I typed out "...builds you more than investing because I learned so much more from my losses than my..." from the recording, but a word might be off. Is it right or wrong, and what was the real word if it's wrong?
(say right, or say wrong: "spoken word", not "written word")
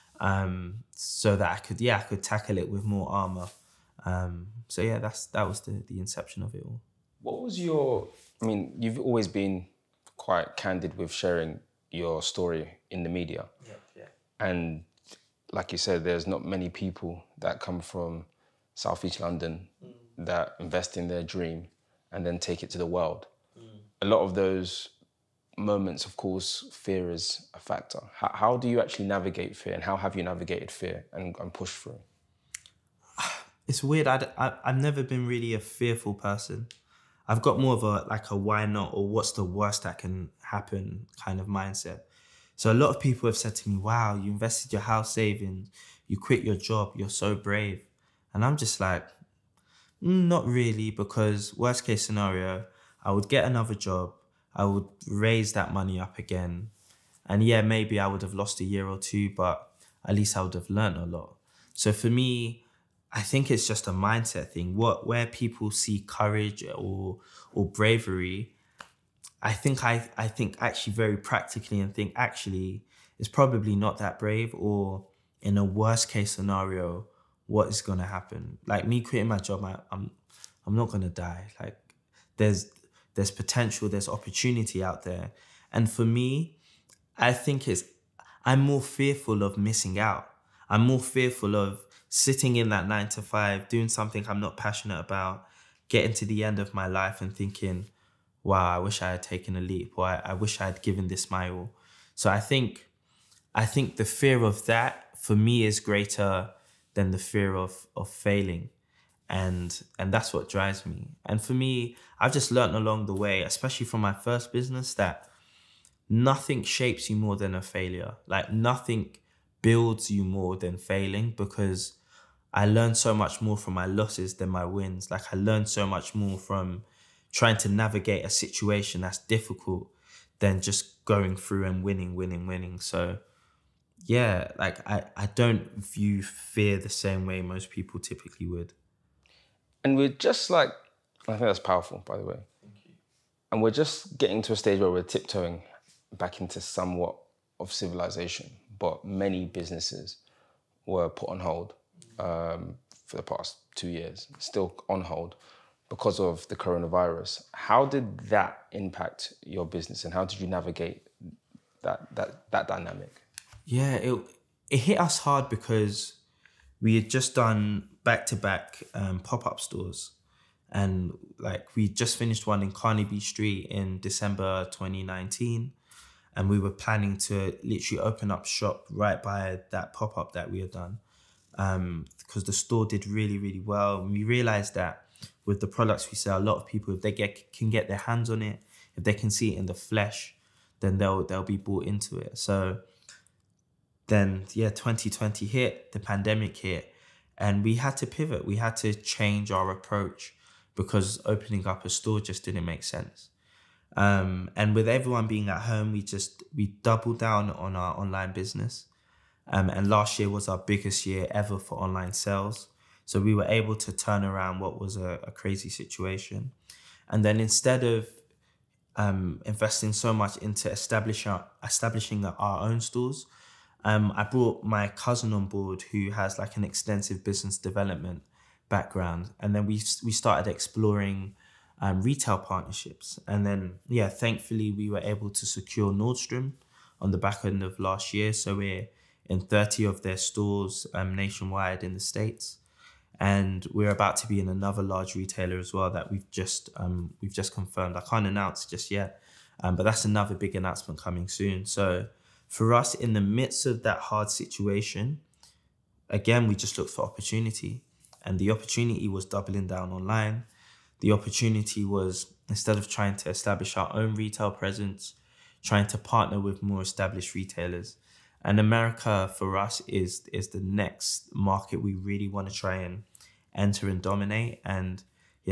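wrong: "failing", not "investing".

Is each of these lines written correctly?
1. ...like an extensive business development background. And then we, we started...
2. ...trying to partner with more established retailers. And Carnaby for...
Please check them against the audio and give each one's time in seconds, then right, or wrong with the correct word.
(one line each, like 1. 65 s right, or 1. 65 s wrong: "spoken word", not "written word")
1. 226 s right
2. 265 s wrong: "America", not "Carnaby".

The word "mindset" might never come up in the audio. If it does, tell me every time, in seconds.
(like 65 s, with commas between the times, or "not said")
41 s, 63 s.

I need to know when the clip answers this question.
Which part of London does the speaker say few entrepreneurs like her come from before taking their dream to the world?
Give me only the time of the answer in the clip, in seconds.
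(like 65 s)
18 s.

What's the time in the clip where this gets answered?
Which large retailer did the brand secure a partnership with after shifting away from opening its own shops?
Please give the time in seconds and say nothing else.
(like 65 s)
235 s.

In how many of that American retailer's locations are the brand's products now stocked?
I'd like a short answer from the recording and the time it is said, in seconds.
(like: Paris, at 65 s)
30, at 239 s.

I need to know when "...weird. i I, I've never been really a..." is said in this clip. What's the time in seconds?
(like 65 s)
33 s.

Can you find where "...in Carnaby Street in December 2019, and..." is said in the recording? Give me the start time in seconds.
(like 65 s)
172 s.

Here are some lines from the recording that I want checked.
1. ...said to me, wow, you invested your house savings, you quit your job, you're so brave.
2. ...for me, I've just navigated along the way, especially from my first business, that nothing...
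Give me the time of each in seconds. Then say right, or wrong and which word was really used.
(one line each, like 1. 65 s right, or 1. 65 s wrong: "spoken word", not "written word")
1. 43 s right
2. 111 s wrong: "learned", not "navigated".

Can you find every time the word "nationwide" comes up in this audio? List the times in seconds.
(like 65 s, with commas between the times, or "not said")
241 s.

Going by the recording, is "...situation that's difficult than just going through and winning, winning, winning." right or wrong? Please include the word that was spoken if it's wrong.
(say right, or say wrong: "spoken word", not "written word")
right.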